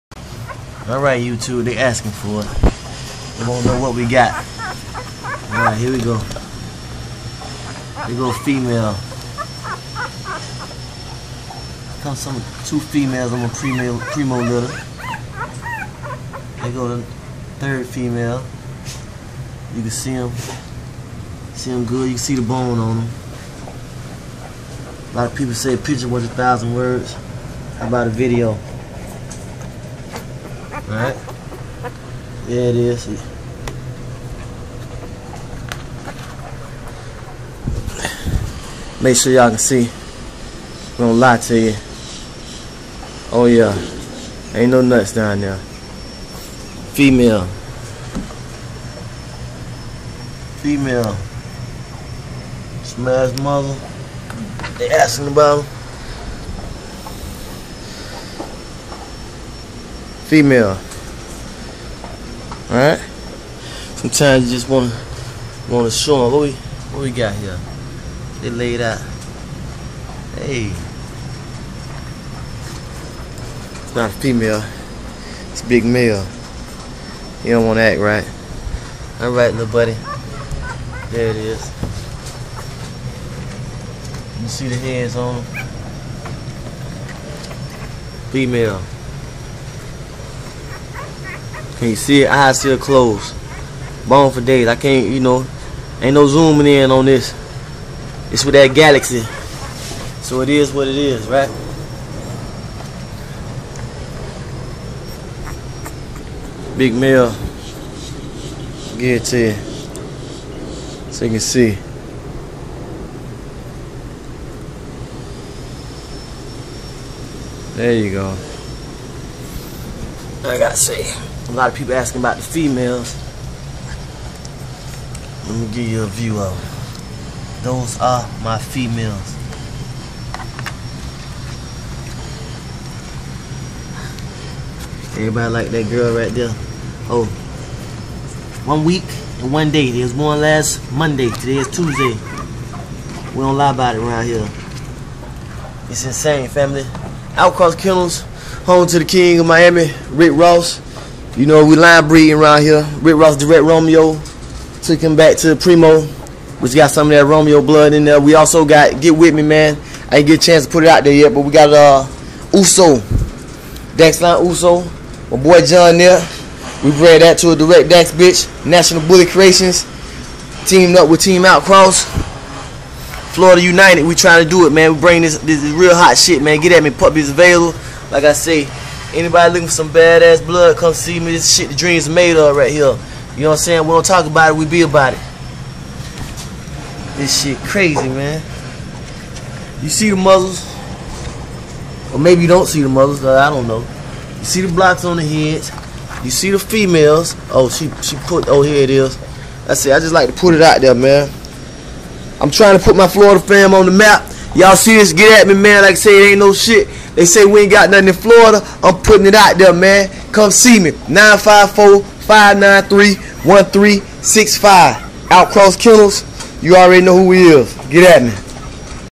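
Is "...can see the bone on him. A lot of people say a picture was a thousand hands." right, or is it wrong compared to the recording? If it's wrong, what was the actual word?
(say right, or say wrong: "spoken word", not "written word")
wrong: "words", not "hands".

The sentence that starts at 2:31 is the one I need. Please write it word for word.
You know, we line breeding around here.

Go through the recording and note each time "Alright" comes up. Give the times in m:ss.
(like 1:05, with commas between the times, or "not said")
0:00, 0:05, 0:30, 1:02, 1:19.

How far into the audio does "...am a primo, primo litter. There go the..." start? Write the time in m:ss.
0:13.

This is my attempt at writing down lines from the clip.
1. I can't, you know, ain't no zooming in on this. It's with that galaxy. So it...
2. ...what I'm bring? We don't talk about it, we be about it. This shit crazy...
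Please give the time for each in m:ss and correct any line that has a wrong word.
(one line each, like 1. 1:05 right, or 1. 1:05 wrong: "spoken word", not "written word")
1. 1:34 right
2. 3:03 wrong: "saying", not "bring".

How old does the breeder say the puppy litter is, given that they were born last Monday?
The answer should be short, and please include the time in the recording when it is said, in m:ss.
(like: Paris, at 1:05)
1 week and 1 day, at 2:18.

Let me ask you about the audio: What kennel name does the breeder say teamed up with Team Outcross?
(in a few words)
National Bully Creations.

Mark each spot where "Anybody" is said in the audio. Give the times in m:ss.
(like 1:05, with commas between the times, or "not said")
2:59.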